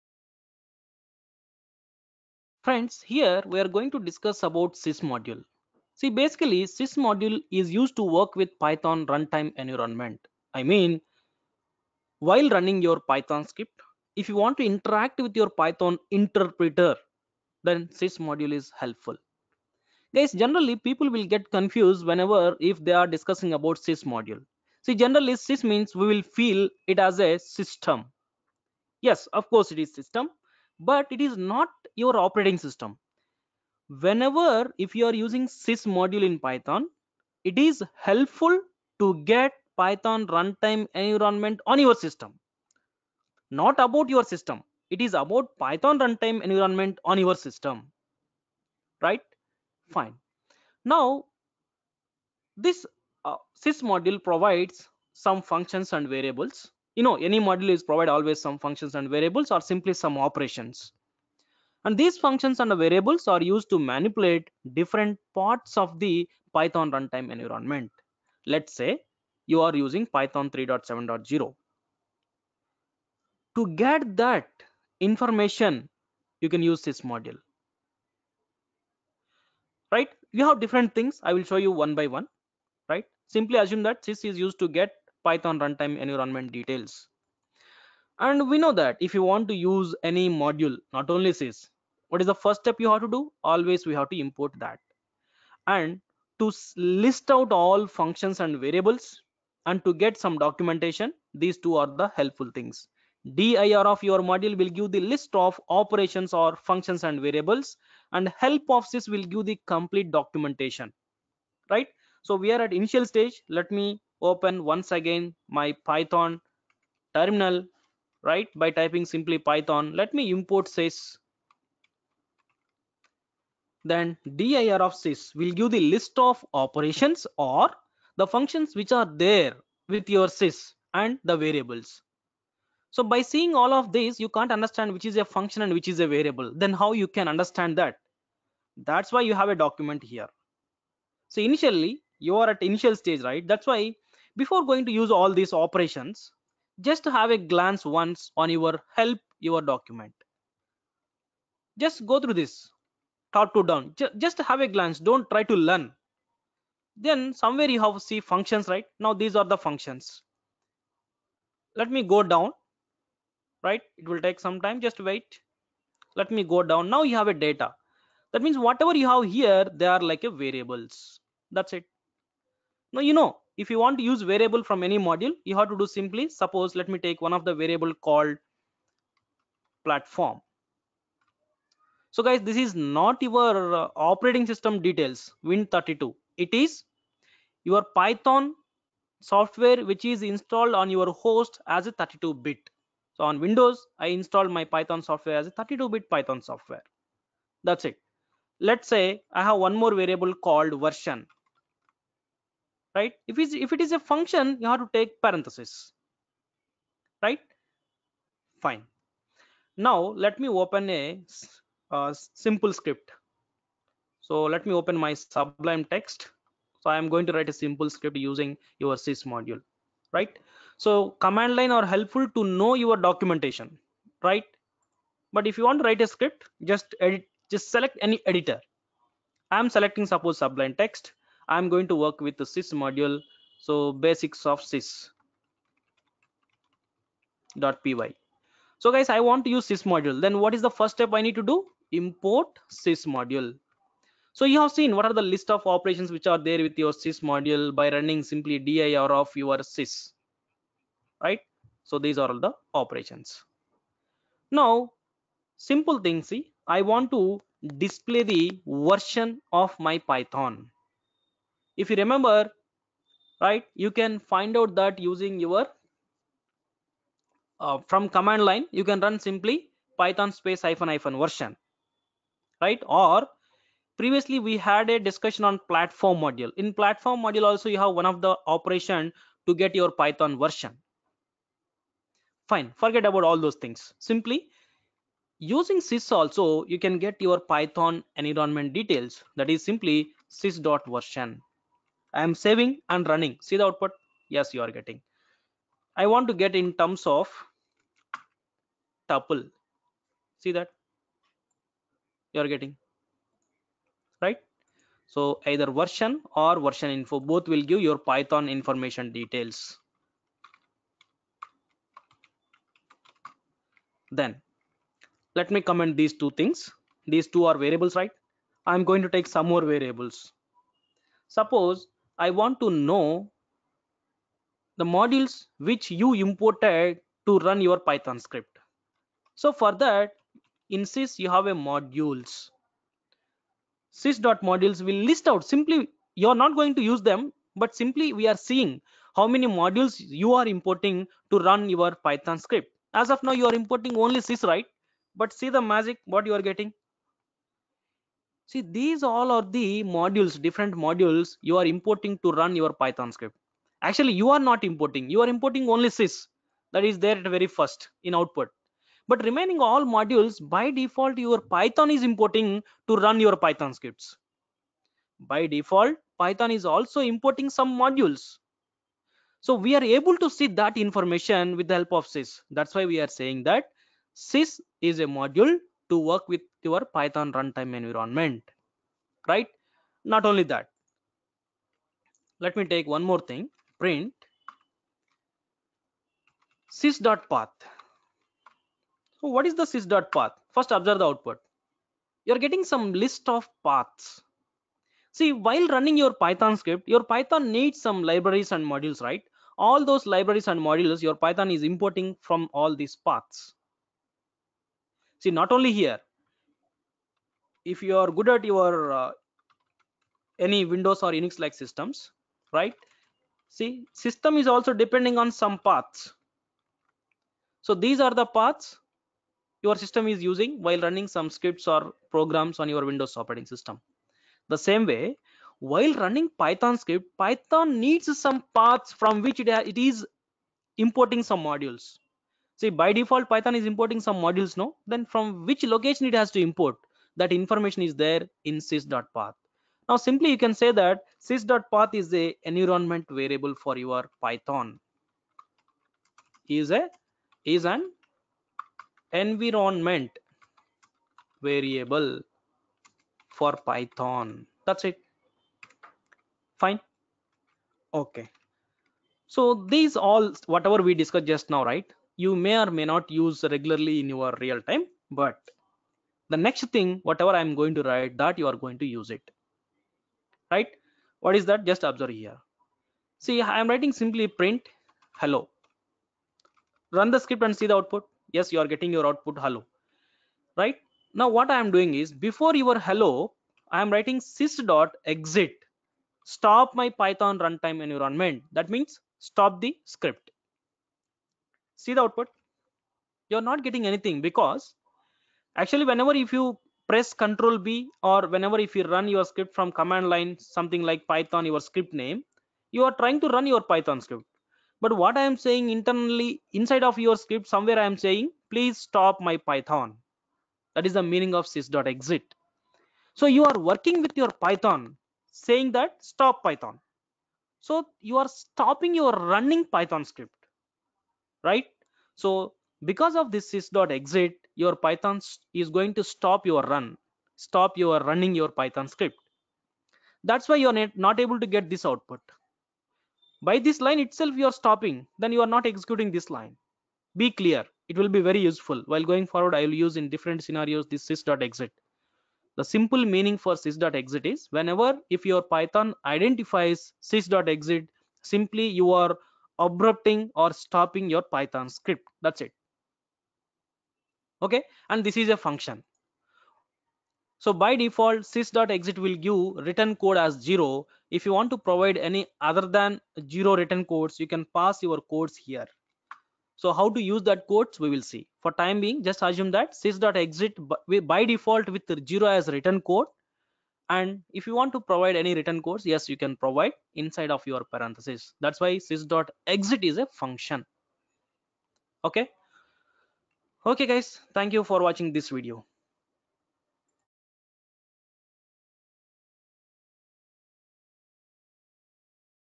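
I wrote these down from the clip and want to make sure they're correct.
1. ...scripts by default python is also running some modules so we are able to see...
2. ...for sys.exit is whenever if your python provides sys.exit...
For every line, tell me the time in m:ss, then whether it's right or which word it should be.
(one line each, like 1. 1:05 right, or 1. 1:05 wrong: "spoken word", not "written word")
1. 6:03 wrong: "importing", not "running"
2. 9:03 wrong: "identifies", not "provides".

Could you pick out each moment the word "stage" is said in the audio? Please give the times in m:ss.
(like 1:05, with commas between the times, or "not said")
1:53, 2:22.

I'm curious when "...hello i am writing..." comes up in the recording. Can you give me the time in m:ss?
8:02.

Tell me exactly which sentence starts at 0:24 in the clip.
See, generally sys means we will feel it as a system.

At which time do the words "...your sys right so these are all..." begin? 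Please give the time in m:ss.
4:09.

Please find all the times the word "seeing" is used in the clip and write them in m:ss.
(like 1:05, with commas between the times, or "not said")
2:13, 5:38.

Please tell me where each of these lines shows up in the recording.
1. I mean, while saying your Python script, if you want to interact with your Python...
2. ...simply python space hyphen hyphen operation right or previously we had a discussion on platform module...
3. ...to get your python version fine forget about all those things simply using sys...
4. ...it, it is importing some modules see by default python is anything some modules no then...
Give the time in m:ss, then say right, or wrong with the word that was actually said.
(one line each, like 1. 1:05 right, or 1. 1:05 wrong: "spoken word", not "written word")
1. 0:10 wrong: "running", not "saying"
2. 4:29 wrong: "version", not "operation"
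3. 4:39 right
4. 7:09 wrong: "importing", not "anything".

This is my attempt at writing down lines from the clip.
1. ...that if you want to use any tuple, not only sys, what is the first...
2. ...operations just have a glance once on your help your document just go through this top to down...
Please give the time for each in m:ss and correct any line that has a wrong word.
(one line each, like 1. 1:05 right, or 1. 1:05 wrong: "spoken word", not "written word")
1. 1:28 wrong: "module", not "tuple"
2. 2:25 right.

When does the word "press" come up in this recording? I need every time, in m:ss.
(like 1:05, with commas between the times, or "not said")
8:16.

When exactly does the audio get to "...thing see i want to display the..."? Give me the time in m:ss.
4:16.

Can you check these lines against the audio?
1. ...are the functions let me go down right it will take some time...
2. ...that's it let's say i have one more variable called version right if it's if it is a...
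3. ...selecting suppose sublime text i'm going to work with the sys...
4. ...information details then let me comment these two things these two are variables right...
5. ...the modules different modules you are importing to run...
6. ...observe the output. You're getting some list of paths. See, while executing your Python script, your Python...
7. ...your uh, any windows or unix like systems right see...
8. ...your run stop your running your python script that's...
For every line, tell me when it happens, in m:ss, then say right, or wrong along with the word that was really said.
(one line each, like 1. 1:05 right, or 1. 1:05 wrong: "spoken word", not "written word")
1. 2:39 right
2. 3:17 right
3. 3:49 right
4. 5:08 right
5. 5:49 right
6. 6:30 wrong: "running", not "executing"
7. 6:48 right
8. 8:46 right.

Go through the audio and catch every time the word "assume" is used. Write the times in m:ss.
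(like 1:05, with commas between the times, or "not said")
1:23, 9:29.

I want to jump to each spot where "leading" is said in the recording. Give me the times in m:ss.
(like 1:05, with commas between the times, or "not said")
not said.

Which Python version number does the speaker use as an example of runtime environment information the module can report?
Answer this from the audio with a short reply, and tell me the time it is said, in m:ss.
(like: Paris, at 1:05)
3.7.0, at 1:10.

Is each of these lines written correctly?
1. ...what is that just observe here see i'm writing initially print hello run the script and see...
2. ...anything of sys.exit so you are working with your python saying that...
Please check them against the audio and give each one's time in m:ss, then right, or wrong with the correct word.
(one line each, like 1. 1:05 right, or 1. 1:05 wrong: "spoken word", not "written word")
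1. 7:51 wrong: "simply", not "initially"
2. 8:31 wrong: "meaning", not "anything".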